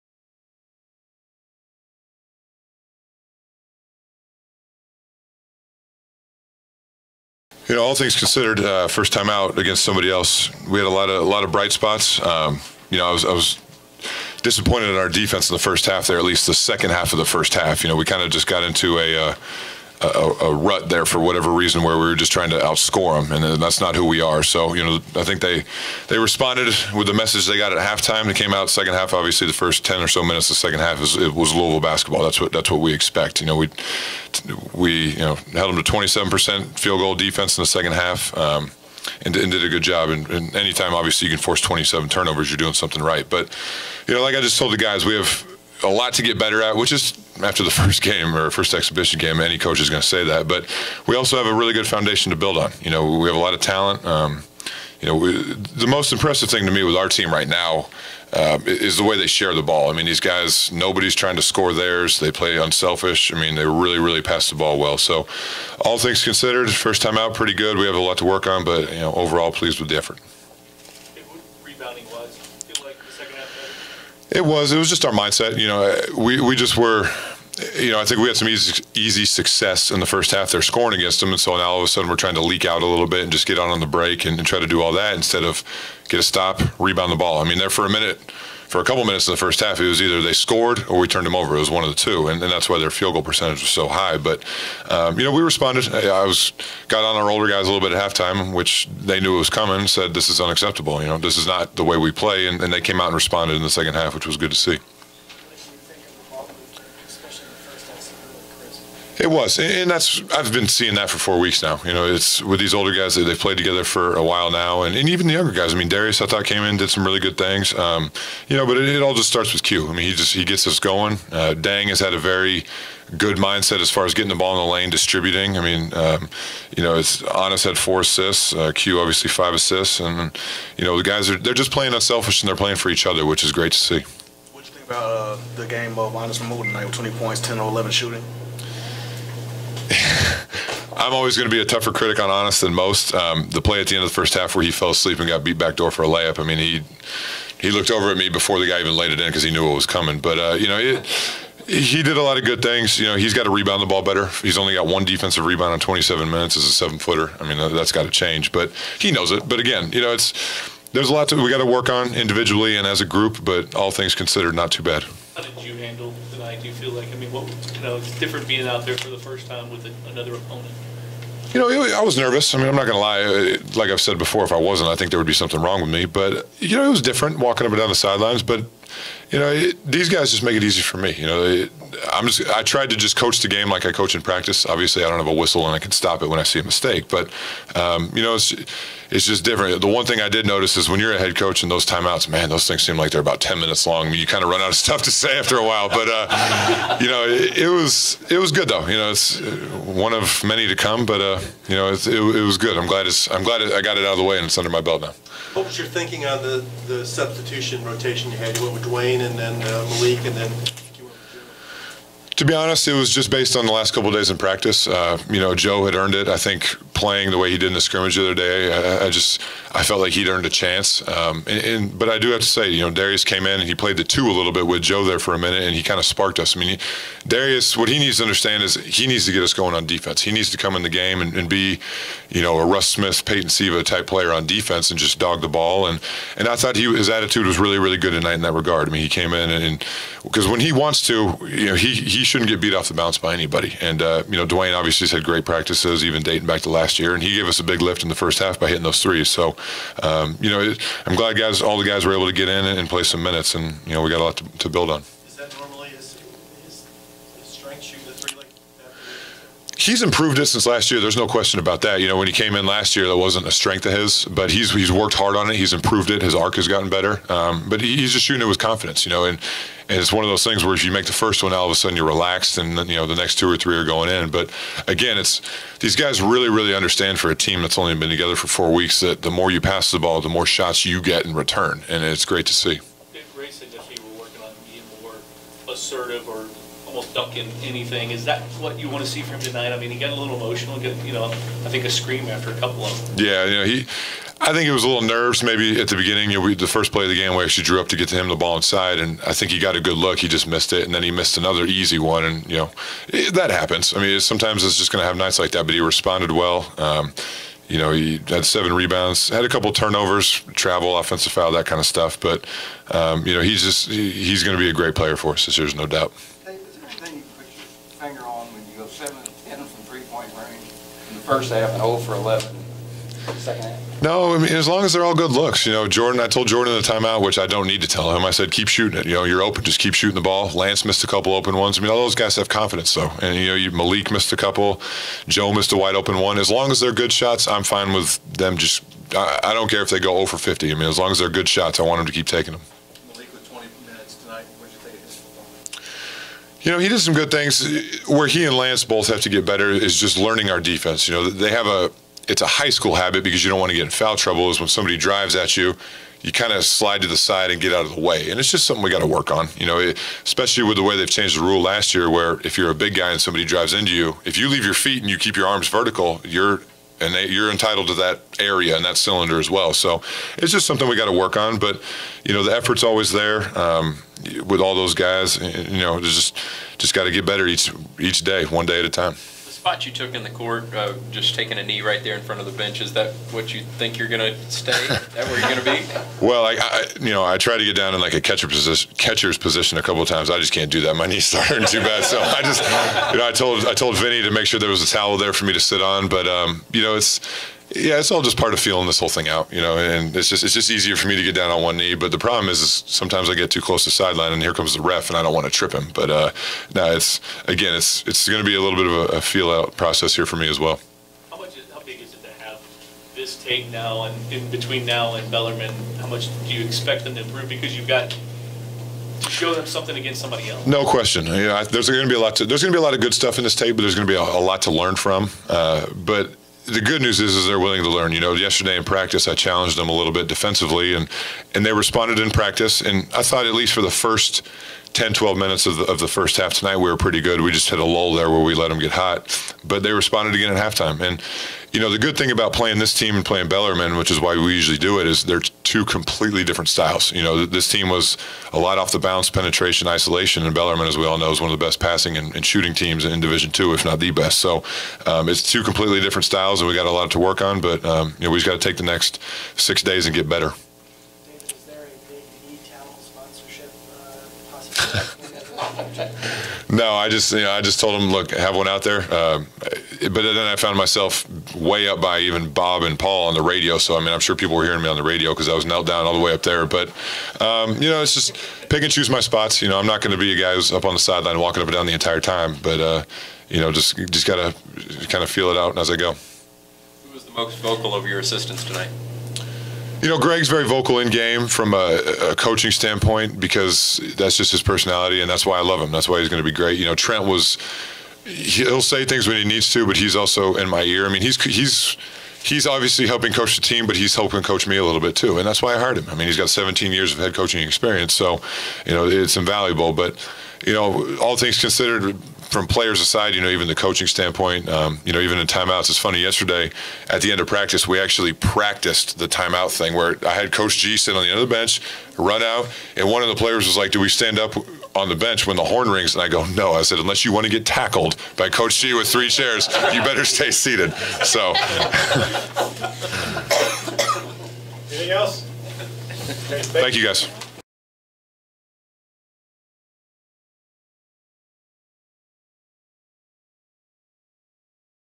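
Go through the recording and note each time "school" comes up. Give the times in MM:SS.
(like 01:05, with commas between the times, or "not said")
05:52.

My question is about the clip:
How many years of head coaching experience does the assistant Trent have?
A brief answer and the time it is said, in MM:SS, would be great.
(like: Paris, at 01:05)
17, at 08:26.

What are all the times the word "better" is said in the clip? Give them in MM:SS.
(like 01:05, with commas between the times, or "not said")
00:46, 02:34, 04:26, 05:49, 06:17, 07:40, 08:50.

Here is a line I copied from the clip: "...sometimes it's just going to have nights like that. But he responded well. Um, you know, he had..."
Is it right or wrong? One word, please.
right.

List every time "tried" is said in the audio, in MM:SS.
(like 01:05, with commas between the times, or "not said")
03:02, 06:27.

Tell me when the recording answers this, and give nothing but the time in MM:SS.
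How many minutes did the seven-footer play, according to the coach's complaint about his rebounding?
02:35.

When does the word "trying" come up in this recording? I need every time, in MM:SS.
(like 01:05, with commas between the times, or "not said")
00:22, 01:01, 01:22.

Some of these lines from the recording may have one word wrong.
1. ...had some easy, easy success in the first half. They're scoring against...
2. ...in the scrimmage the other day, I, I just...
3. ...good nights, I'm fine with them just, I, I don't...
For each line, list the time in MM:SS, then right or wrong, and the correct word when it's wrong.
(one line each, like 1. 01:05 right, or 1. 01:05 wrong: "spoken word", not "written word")
1. 01:18 right
2. 03:37 right
3. 05:36 wrong: "shots", not "nights".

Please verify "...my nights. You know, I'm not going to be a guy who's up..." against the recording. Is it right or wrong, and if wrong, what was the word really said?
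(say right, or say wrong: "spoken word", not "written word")
wrong: "spots", not "nights".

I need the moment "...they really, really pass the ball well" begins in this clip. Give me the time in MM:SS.
01:03.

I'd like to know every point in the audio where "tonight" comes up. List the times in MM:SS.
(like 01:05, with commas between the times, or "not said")
02:16, 03:58, 04:49, 07:16, 08:08.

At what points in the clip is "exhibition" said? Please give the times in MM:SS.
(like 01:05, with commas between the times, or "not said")
00:48.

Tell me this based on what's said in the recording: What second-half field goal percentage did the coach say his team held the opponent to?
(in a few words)
27 percent.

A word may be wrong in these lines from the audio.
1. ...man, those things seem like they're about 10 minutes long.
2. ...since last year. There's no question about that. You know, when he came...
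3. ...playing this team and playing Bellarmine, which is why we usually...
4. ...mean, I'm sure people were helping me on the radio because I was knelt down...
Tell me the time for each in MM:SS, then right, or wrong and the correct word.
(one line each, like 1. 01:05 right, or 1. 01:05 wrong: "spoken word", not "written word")
1. 03:12 right
2. 04:20 right
3. 07:22 right
4. 07:53 wrong: "hearing", not "helping".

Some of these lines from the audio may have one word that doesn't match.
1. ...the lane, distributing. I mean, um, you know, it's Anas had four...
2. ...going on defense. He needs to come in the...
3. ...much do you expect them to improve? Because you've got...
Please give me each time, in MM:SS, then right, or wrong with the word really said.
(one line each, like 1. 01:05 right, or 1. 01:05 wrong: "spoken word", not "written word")
1. 02:04 right
2. 03:49 right
3. 06:56 right.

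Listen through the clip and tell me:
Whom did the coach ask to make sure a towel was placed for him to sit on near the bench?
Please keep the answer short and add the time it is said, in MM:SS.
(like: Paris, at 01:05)
Vinny, at 06:33.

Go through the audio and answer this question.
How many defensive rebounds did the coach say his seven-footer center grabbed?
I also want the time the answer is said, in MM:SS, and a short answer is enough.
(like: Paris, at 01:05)
1, at 02:34.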